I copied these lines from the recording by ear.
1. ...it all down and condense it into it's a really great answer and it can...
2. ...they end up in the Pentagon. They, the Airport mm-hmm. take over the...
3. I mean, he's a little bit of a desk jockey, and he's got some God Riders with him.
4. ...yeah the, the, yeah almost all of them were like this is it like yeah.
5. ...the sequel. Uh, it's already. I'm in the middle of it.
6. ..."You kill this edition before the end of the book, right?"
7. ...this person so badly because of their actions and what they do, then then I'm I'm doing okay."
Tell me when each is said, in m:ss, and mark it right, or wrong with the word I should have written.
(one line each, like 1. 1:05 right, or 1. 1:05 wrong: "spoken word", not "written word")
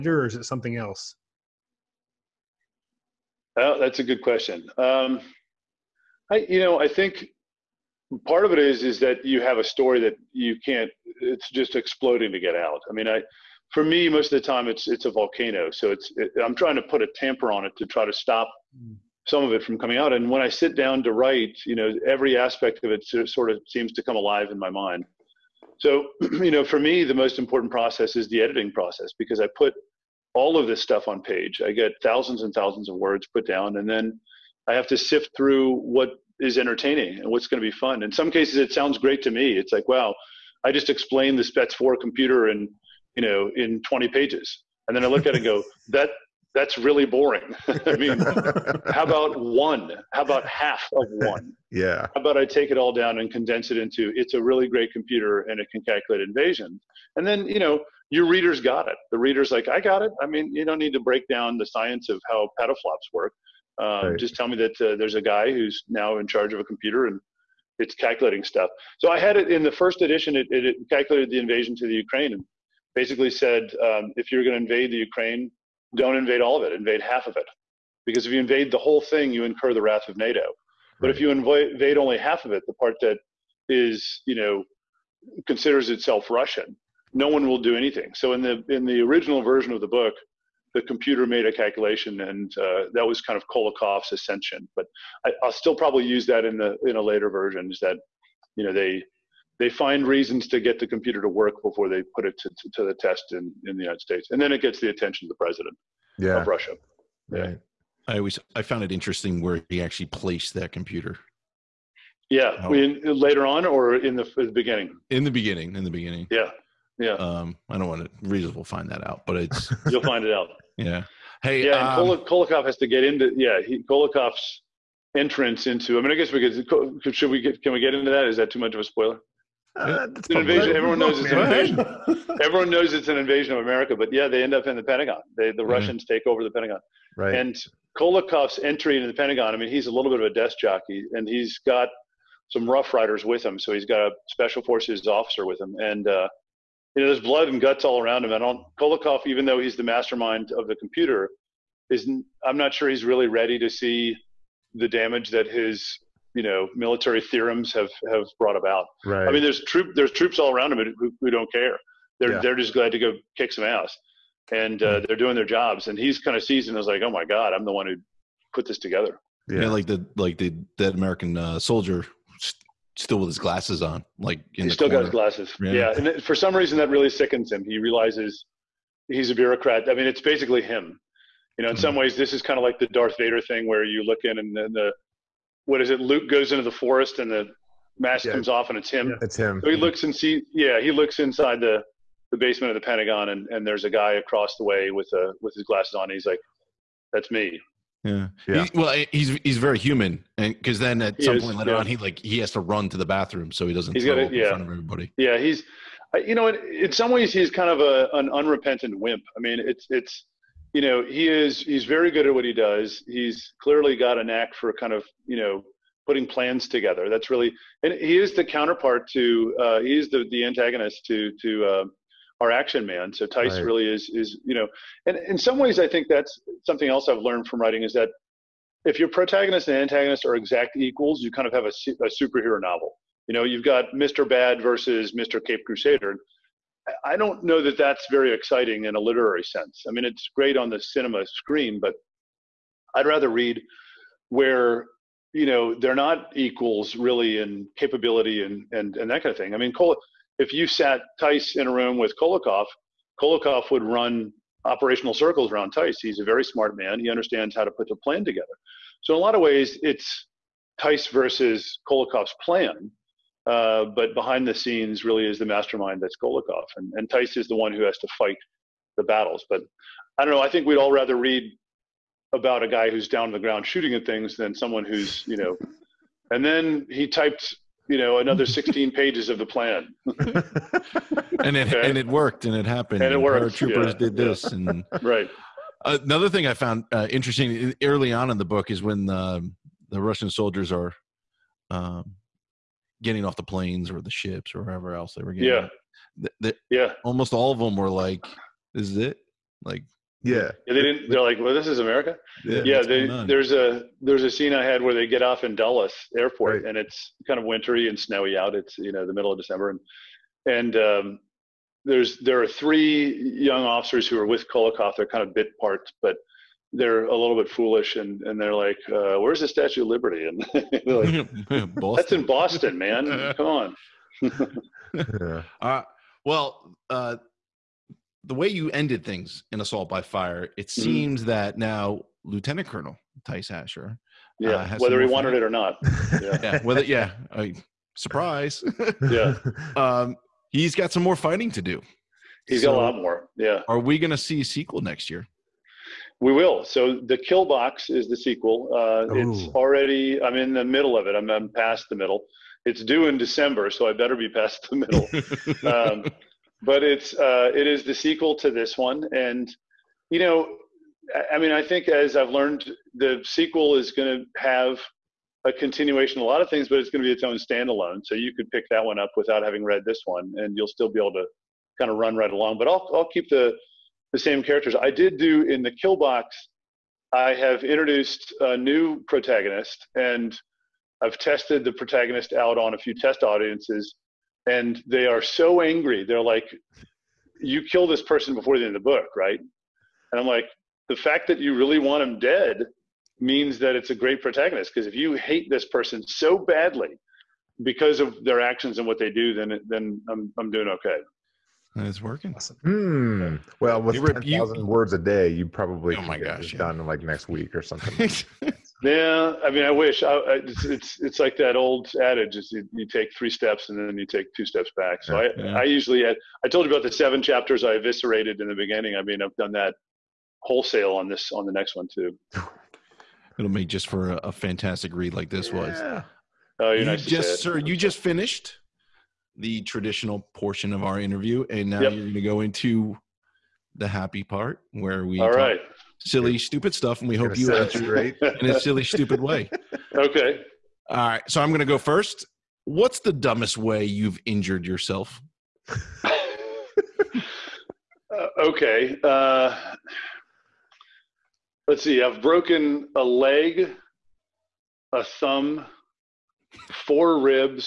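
1. 0:52 wrong: "computer", not "answer"
2. 2:14 wrong: "Russians", not "Airport"
3. 2:19 wrong: "Rough", not "God"
4. 4:55 right
5. 5:48 right
6. 6:27 wrong: "person", not "edition"
7. 6:35 right.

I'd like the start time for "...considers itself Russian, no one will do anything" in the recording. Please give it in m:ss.
1:25.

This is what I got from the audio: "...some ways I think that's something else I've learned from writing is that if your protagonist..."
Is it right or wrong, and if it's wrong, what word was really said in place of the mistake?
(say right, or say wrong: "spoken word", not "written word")
right.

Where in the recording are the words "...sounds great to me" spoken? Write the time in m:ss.
0:38.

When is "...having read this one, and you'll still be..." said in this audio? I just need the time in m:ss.
6:09.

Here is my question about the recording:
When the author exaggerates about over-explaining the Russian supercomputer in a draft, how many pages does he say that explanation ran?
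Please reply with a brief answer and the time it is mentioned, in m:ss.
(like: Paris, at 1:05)
20, at 0:43.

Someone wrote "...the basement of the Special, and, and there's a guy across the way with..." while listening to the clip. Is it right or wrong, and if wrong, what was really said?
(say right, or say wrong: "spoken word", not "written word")
wrong: "Pentagon", not "Special".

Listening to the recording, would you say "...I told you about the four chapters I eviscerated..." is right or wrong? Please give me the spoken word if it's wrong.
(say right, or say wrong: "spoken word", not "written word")
wrong: "seven", not "four".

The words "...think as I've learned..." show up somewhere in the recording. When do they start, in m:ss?
6:01.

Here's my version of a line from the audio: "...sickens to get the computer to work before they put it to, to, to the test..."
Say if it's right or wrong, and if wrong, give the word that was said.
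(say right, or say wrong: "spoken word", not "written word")
wrong: "reasons", not "sickens".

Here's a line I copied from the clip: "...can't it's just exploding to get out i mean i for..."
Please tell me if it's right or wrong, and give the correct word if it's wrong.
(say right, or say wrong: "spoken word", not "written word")
right.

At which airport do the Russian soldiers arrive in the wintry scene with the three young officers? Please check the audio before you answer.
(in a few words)
Dulles Airport.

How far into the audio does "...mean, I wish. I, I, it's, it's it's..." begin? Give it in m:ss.
6:49.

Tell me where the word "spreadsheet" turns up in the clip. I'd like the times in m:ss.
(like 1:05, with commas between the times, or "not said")
not said.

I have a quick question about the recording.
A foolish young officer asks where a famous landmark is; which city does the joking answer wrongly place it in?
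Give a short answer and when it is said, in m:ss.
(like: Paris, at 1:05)
Boston, at 5:22.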